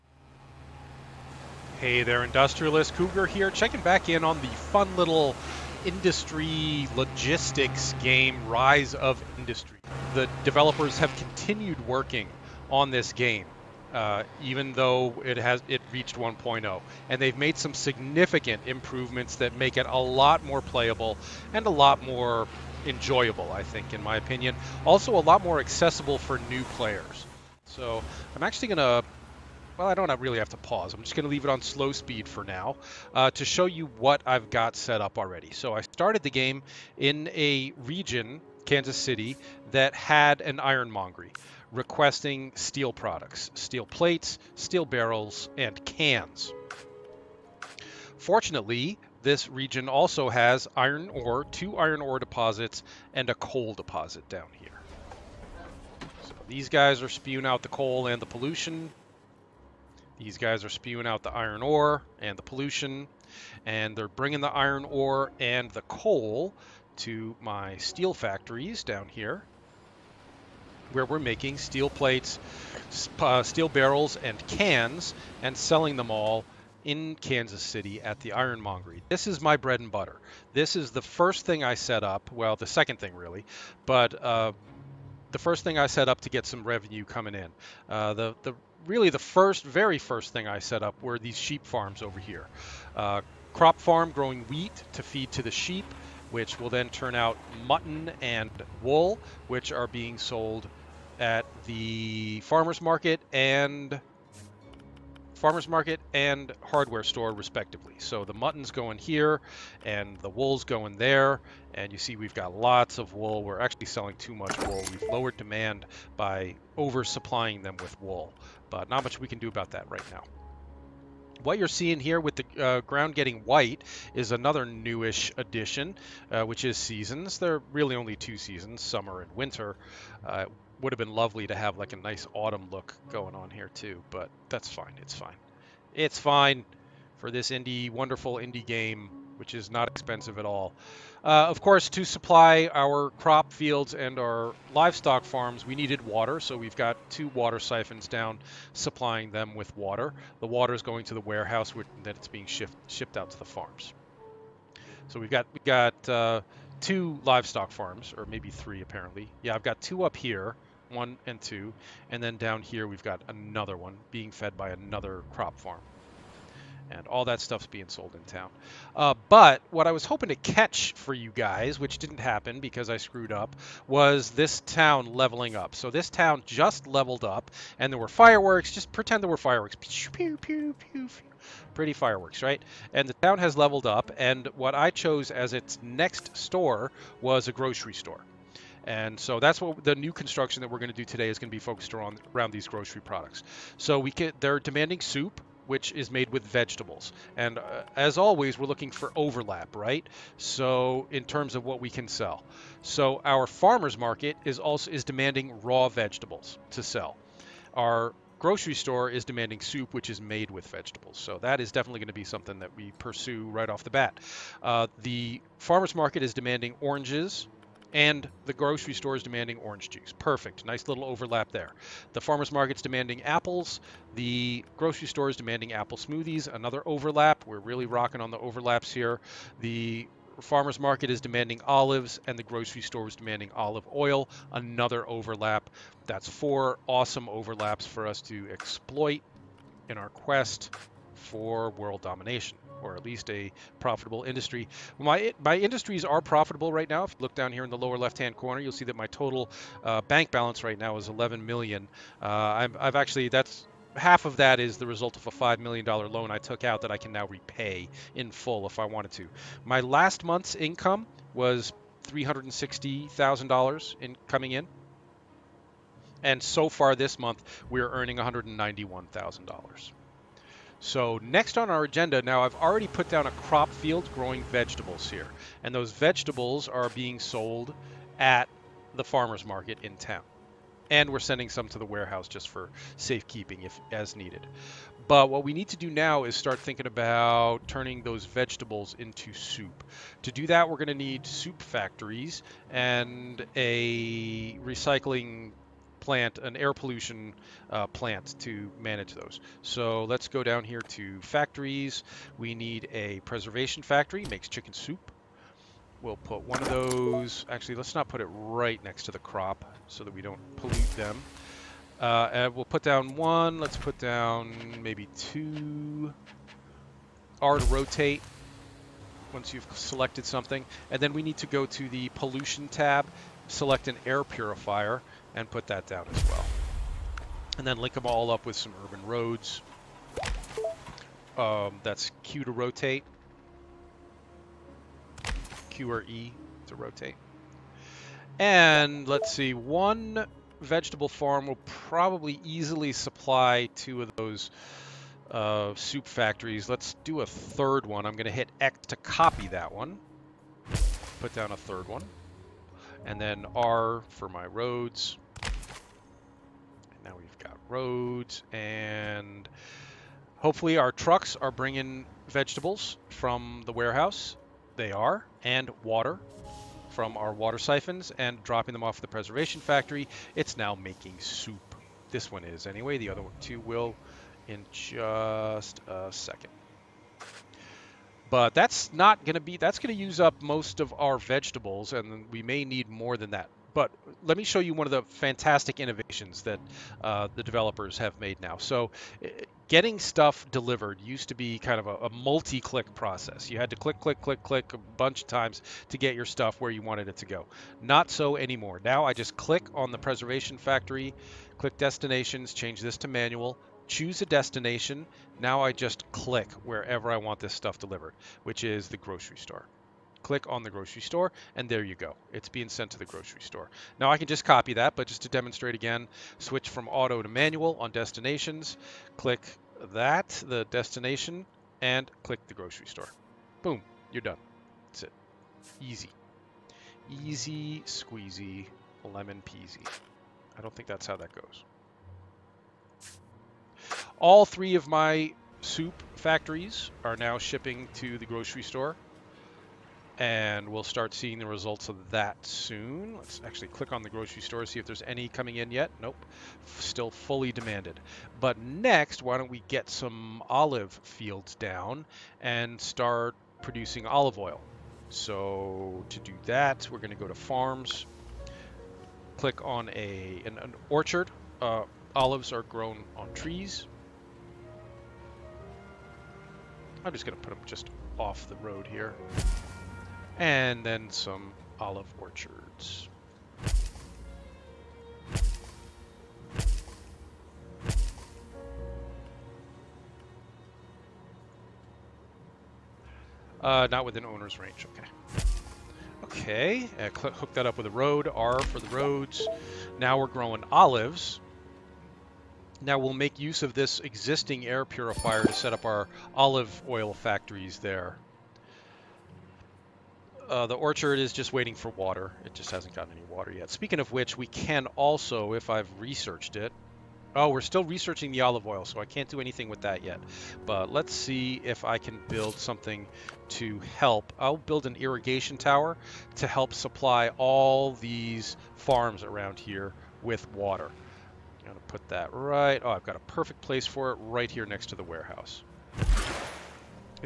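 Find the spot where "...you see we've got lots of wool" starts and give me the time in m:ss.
1:51.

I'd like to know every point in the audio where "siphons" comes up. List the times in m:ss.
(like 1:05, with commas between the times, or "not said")
2:27, 6:07.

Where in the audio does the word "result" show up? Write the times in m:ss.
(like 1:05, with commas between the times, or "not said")
4:14, 7:21.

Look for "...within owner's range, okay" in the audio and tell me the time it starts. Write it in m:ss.
8:04.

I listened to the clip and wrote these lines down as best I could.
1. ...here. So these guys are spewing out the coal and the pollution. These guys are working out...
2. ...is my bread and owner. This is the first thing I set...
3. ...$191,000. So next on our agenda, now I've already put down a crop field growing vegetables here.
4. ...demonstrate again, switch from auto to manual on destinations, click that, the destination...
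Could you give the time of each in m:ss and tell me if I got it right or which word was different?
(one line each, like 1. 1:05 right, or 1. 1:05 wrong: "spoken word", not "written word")
1. 0:54 wrong: "spewing", not "working"
2. 1:19 wrong: "butter", not "owner"
3. 4:28 right
4. 6:55 right.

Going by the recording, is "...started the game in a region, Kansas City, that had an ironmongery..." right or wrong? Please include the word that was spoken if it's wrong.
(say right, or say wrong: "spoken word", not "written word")
right.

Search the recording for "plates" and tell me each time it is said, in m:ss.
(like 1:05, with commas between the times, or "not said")
0:43, 1:11.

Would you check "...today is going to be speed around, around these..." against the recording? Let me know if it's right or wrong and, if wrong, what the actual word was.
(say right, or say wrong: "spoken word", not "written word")
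wrong: "focused", not "speed".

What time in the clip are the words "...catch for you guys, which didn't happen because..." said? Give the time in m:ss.
2:50.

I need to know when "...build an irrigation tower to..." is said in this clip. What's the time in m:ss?
8:34.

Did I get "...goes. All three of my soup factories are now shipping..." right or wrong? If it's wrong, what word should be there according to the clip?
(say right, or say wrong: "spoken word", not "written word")
right.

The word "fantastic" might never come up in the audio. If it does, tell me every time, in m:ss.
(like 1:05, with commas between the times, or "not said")
6:25.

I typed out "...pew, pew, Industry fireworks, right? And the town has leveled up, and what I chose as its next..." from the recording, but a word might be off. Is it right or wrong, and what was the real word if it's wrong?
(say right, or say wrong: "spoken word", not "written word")
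wrong: "Pretty", not "Industry".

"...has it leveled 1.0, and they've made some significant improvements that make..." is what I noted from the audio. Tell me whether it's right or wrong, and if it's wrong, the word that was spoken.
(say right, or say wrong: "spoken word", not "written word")
wrong: "reached", not "leveled".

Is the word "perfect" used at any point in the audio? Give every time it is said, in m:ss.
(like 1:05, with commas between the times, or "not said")
3:40, 8:43.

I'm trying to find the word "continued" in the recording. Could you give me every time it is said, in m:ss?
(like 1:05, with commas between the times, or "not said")
0:11.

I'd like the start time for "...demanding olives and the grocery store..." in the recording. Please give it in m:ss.
3:51.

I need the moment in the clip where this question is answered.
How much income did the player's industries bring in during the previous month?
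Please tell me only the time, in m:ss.
4:22.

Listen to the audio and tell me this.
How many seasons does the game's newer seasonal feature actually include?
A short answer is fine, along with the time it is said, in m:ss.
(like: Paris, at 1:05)
2, at 2:08.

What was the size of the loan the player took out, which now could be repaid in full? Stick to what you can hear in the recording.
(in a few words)
$5 million.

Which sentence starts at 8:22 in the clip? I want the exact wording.
It just hasn't gotten any water yet.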